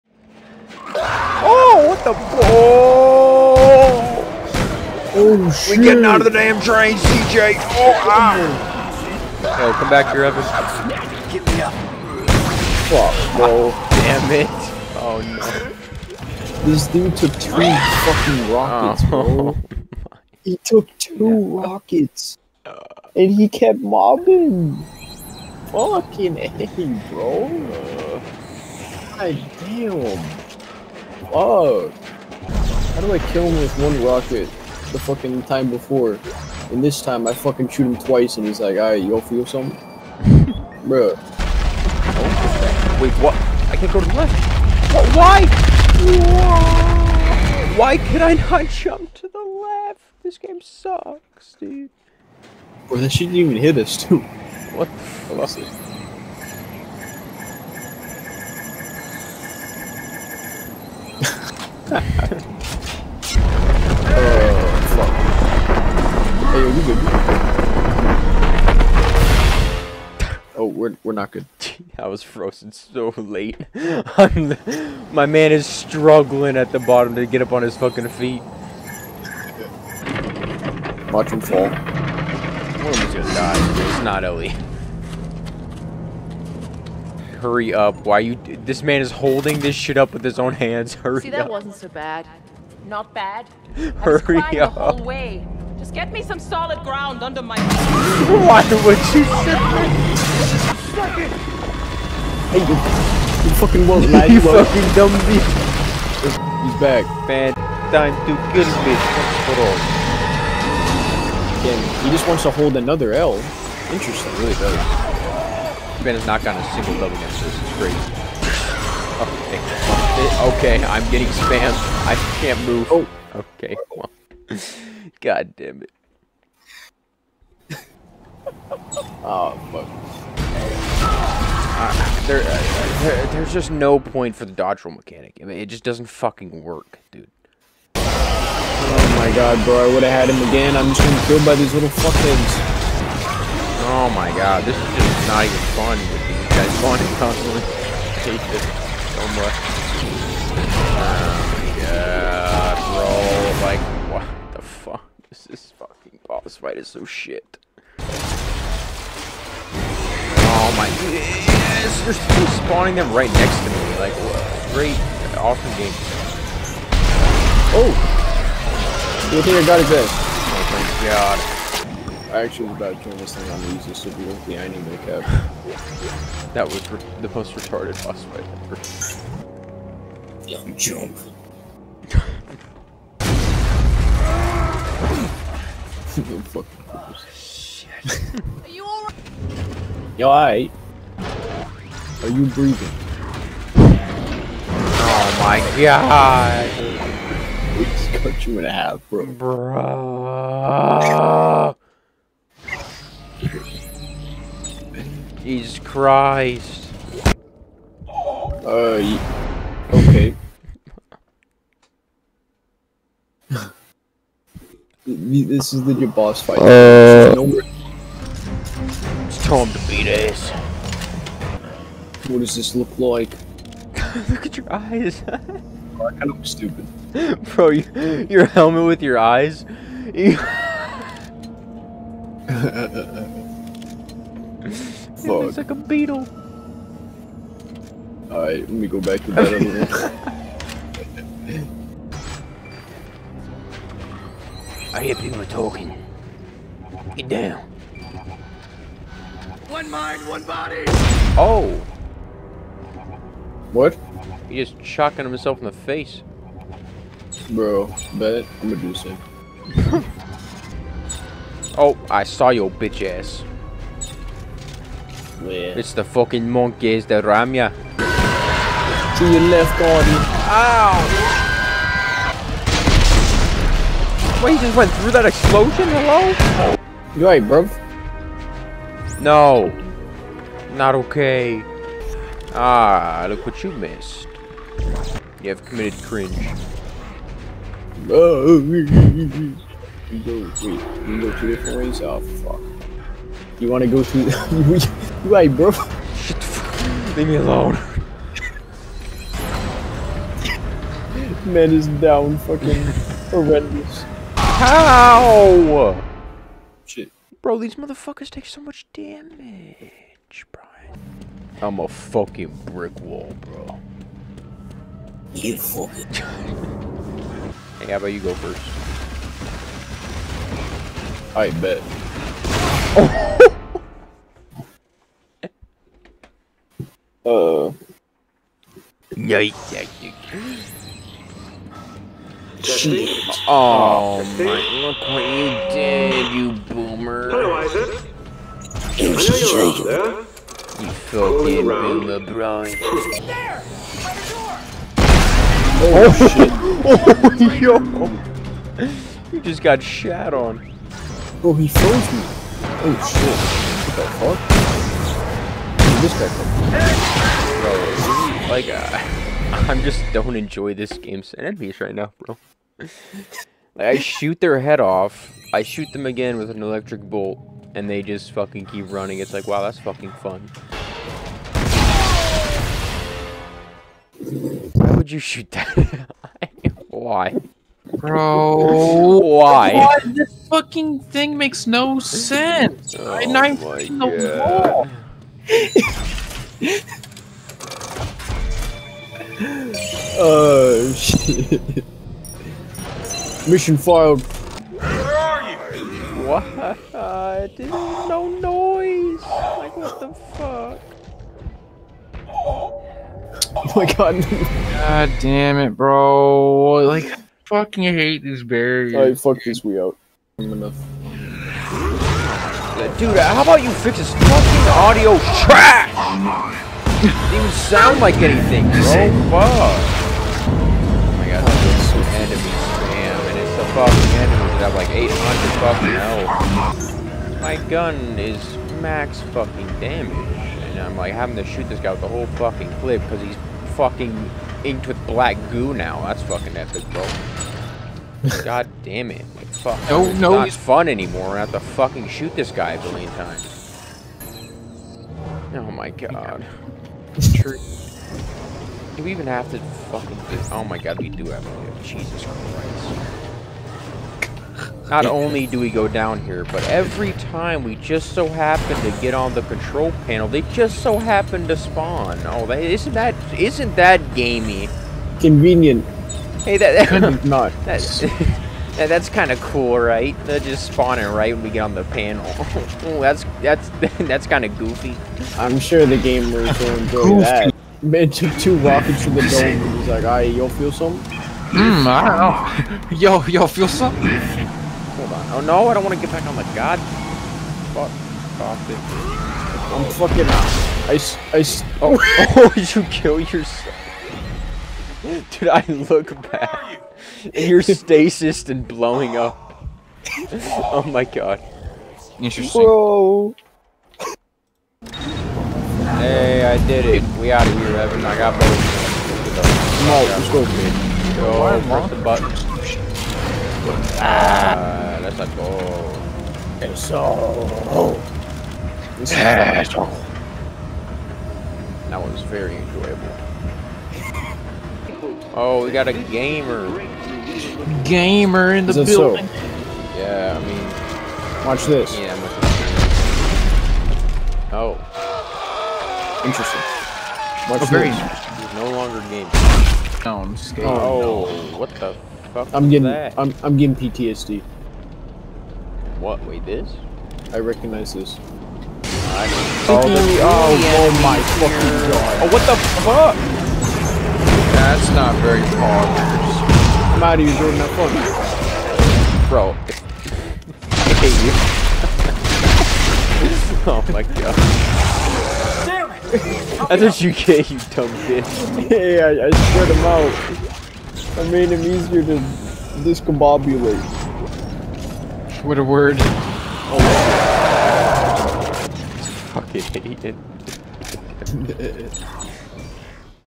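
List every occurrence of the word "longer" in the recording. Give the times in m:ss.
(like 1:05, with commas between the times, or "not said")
8:58.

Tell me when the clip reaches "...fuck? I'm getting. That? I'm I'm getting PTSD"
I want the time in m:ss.
9:02.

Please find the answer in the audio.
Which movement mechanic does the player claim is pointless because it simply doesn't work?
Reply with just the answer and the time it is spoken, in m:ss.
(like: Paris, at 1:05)
dodge roll, at 2:14.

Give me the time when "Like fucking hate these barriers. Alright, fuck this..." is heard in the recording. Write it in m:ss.
6:46.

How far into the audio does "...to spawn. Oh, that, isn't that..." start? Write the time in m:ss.
7:41.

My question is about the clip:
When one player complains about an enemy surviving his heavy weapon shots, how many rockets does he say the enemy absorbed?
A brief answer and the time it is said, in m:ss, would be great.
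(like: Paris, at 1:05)
2, at 0:17.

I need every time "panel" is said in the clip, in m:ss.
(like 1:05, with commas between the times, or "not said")
7:40, 7:51.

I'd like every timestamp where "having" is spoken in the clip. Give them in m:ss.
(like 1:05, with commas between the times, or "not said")
7:11.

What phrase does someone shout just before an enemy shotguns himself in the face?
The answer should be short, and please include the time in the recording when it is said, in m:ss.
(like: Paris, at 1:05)
One mind, one body, at 4:09.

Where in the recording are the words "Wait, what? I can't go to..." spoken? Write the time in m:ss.
0:43.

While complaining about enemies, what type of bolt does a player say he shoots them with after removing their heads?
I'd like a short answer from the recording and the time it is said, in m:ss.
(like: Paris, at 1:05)
electric bolt, at 6:06.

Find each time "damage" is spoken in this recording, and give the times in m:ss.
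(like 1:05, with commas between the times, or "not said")
5:08, 7:09.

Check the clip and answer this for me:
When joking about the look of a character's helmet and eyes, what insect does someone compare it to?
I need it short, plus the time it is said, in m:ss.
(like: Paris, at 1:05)
beetle, at 3:55.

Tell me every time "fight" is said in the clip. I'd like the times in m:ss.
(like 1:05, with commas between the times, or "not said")
2:36, 2:58, 3:36.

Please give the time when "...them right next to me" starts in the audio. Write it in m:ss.
2:42.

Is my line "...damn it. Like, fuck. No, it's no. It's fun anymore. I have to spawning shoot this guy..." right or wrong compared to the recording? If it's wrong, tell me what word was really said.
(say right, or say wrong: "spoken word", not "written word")
wrong: "fucking", not "spawning".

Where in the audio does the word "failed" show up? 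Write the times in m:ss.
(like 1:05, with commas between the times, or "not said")
6:33.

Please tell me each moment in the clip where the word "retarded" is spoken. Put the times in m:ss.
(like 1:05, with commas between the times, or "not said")
2:57.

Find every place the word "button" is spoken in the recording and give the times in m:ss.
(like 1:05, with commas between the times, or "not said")
8:31.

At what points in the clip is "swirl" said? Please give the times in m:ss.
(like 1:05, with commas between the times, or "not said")
not said.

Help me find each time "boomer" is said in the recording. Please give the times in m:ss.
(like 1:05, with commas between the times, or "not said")
5:36, 5:41.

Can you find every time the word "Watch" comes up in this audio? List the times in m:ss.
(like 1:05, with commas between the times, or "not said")
1:21, 8:51, 8:57.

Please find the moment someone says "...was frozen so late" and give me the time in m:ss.
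1:12.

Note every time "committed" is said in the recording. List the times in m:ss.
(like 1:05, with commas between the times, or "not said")
4:45.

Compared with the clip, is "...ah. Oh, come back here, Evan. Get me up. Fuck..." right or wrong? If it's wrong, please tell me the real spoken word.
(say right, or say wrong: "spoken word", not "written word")
right.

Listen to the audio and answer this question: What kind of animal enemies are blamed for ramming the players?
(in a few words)
monkeys.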